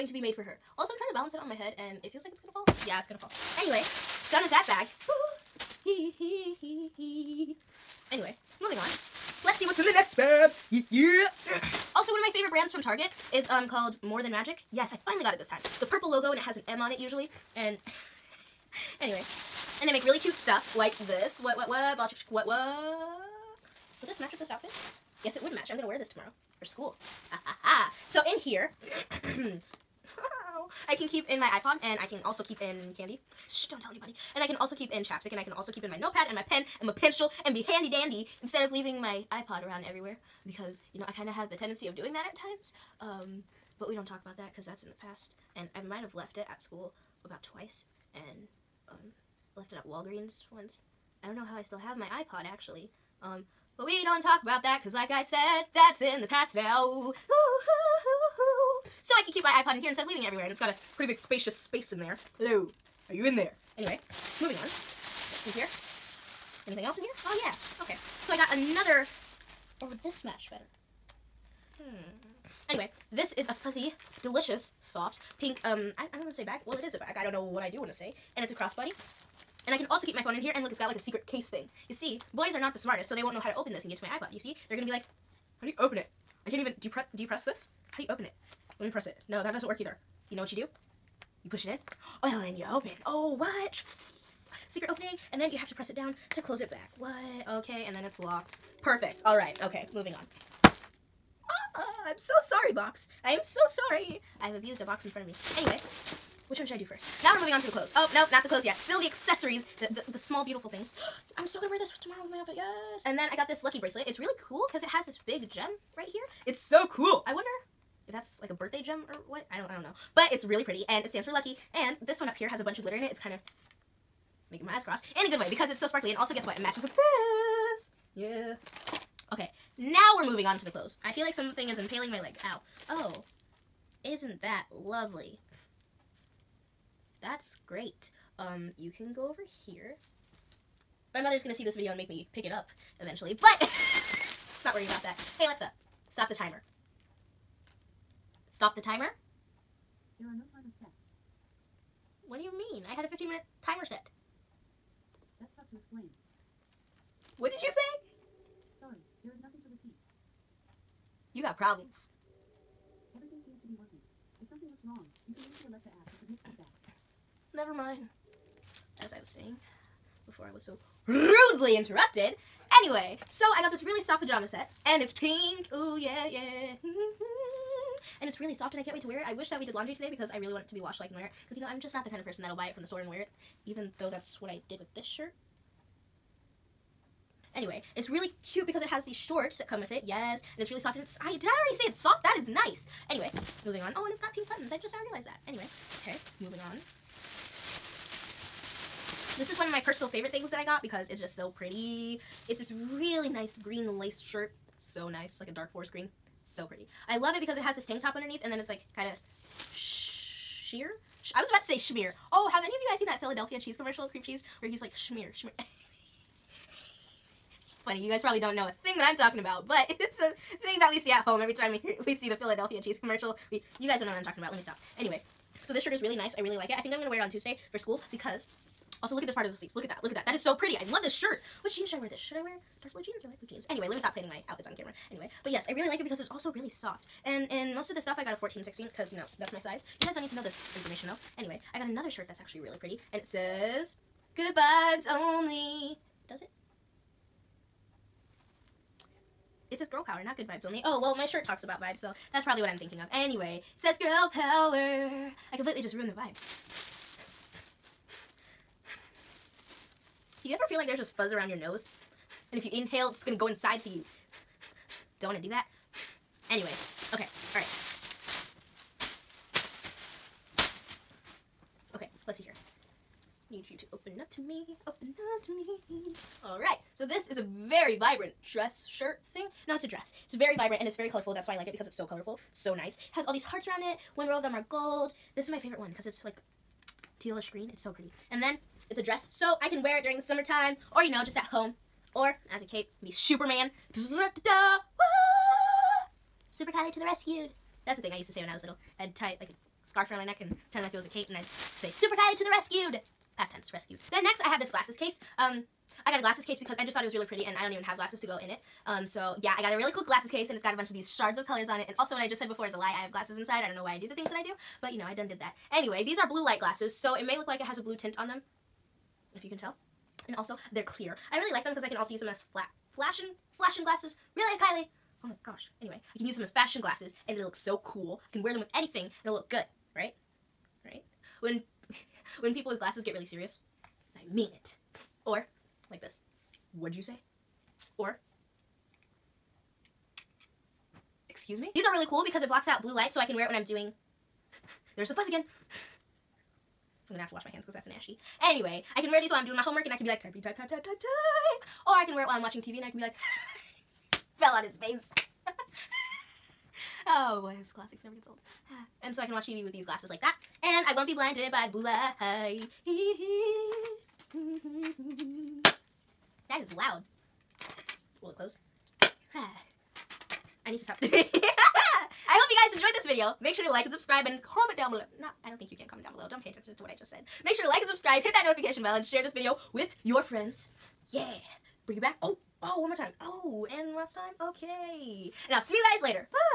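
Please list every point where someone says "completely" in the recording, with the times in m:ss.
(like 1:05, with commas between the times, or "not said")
4:15.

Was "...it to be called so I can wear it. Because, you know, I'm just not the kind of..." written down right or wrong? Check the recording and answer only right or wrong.
wrong.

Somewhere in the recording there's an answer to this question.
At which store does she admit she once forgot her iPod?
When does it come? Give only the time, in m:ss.
0:49.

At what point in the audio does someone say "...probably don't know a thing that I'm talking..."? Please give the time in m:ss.
3:38.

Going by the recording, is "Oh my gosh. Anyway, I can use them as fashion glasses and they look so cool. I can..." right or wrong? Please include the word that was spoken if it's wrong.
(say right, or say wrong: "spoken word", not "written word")
right.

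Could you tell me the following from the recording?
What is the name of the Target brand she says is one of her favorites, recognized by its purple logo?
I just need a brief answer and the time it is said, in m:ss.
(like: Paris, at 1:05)
More Than Magic, at 0:14.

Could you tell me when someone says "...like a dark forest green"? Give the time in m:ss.
3:25.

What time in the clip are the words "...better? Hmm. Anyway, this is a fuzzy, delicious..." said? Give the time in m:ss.
1:10.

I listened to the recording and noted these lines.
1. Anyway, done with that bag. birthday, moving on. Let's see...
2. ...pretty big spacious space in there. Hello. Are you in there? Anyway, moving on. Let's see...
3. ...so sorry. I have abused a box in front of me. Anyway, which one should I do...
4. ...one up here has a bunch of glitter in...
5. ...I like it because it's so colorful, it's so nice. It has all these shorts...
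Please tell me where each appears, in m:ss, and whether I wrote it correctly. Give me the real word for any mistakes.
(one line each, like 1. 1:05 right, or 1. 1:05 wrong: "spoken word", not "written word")
1. 0:03 wrong: "anyway", not "birthday"
2. 1:00 right
3. 1:43 right
4. 2:02 right
5. 4:41 wrong: "hearts", not "shorts".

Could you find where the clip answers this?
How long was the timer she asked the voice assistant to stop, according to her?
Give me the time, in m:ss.
2:33.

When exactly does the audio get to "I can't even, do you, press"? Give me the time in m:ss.
1:26.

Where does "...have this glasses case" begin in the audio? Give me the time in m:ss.
5:04.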